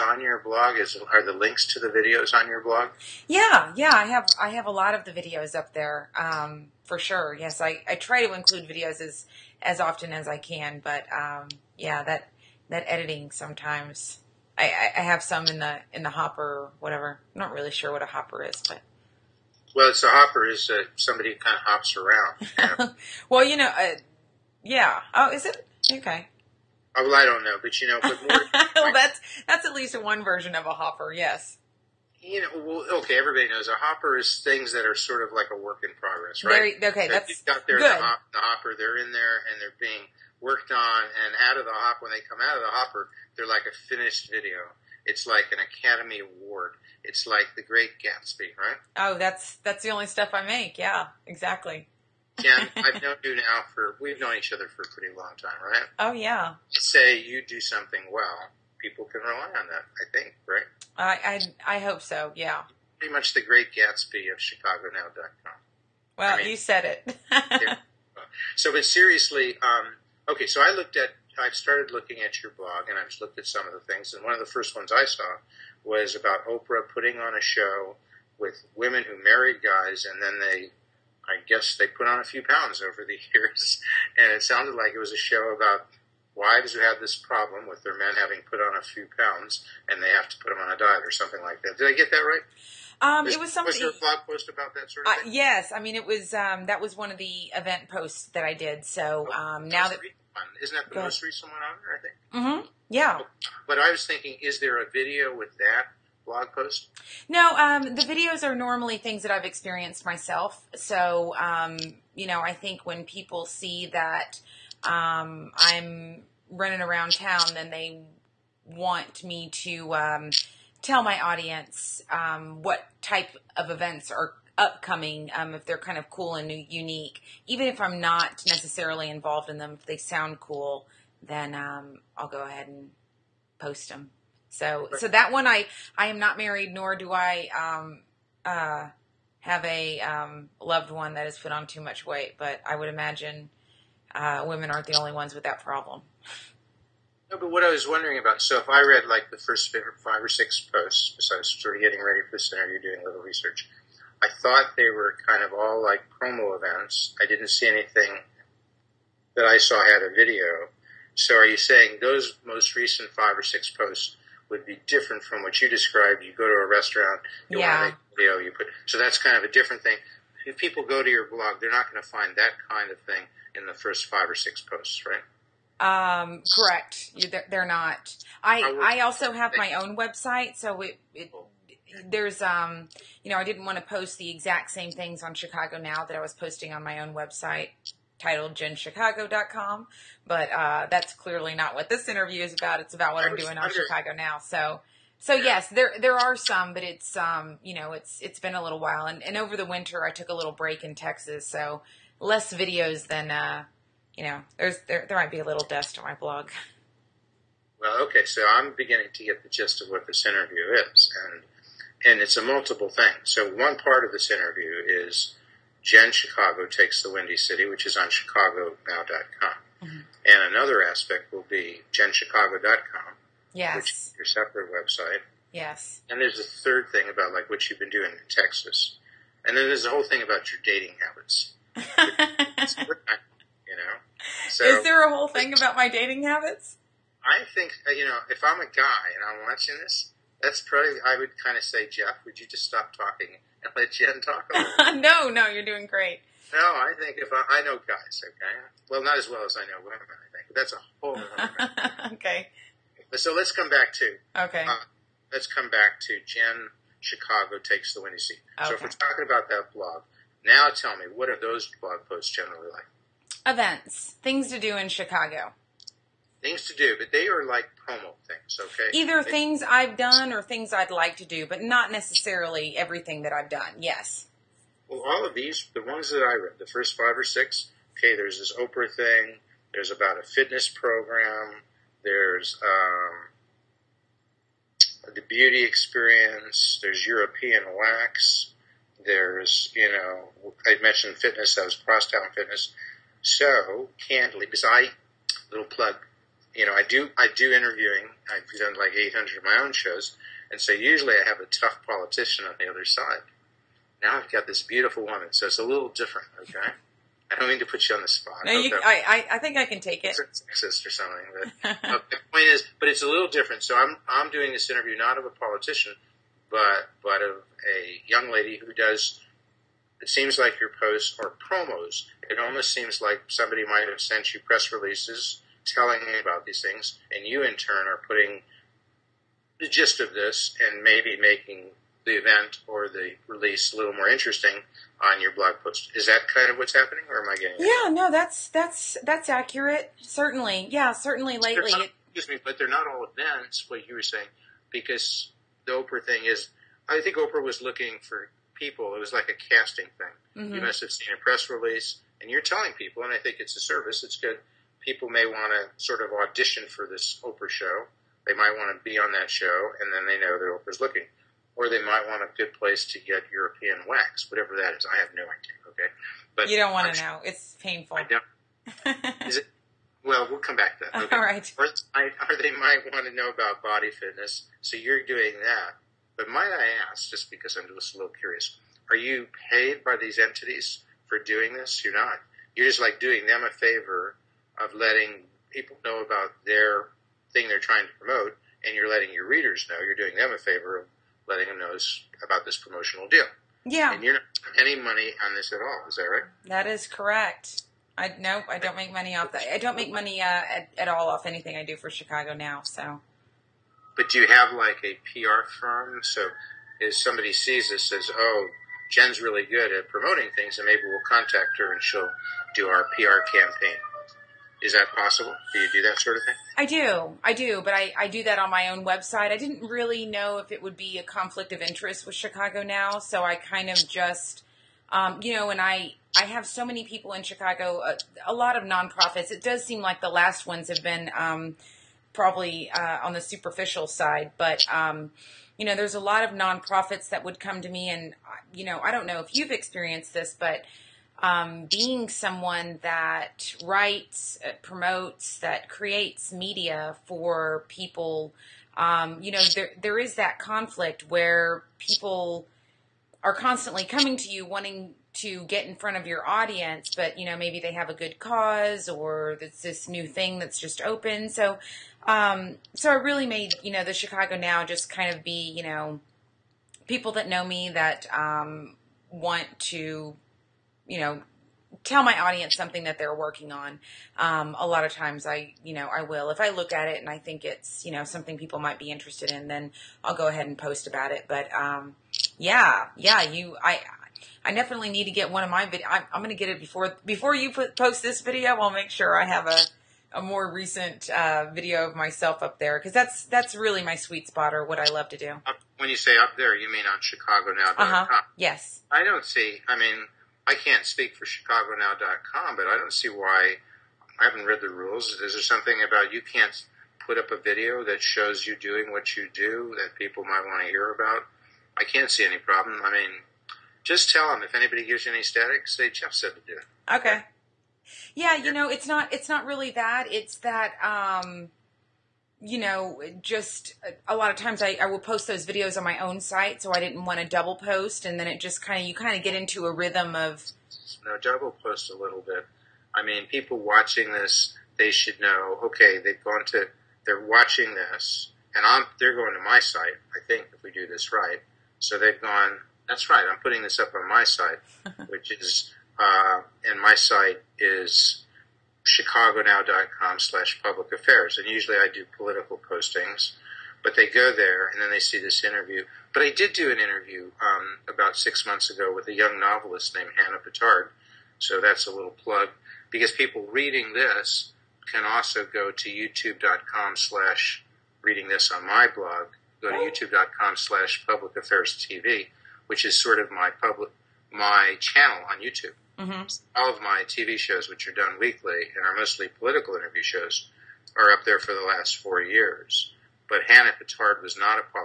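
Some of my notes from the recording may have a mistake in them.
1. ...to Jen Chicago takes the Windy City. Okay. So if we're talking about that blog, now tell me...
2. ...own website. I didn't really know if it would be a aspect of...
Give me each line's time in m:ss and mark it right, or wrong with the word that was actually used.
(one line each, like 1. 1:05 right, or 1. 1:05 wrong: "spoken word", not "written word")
1. 4:16 right
2. 6:58 wrong: "conflict", not "aspect".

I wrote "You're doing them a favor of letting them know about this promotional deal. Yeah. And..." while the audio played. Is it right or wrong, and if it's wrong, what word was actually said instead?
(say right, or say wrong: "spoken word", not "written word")
right.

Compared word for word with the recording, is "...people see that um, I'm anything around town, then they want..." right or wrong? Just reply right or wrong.
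wrong.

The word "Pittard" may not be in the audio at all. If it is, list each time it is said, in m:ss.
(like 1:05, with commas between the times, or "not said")
9:20, 9:43.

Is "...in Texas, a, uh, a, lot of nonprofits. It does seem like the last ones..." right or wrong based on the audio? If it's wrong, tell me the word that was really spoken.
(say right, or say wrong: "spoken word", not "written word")
wrong: "Chicago", not "Texas".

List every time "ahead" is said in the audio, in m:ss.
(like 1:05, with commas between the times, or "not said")
2:12, 8:00.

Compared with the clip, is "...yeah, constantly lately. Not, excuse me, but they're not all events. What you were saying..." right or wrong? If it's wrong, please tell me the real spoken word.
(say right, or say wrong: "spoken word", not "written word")
wrong: "certainly", not "constantly".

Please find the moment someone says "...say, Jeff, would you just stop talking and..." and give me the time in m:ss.
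4:01.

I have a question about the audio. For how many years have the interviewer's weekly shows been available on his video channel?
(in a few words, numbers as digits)
4.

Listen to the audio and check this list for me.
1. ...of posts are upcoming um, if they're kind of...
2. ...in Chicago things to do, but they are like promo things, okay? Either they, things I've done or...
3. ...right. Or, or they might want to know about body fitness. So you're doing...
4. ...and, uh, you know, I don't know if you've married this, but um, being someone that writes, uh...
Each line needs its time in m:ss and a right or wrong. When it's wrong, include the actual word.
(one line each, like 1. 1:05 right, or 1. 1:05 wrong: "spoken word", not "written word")
1. 2:03 wrong: "events", not "posts"
2. 4:24 right
3. 6:11 right
4. 7:17 wrong: "experienced", not "married".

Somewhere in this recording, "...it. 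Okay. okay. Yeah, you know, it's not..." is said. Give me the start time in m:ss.
8:36.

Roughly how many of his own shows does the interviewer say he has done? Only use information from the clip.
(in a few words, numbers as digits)
800.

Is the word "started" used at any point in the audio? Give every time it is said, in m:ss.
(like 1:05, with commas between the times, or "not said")
1:11.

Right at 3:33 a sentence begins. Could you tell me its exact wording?
So one part of this interview is Jen Chicago takes the Windy City, which is on ChicagoNow.com.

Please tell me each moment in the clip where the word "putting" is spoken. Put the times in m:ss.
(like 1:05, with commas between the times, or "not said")
1:16, 5:28, 9:03.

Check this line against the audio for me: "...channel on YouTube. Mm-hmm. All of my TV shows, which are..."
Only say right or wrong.
right.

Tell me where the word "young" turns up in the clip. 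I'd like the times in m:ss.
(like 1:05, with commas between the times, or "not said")
5:18, 9:19.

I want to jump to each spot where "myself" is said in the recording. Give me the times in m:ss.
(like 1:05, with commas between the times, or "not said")
1:50, 8:11.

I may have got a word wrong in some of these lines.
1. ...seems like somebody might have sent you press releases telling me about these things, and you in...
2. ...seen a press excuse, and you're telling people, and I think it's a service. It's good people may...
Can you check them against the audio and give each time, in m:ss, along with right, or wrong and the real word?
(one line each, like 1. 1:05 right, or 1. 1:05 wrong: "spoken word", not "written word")
1. 5:22 right
2. 5:50 wrong: "release", not "excuse".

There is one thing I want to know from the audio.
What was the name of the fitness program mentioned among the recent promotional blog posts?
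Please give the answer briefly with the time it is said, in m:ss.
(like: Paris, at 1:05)
Crosstown Fitness, at 4:51.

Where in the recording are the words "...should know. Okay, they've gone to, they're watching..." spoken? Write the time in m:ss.
8:54.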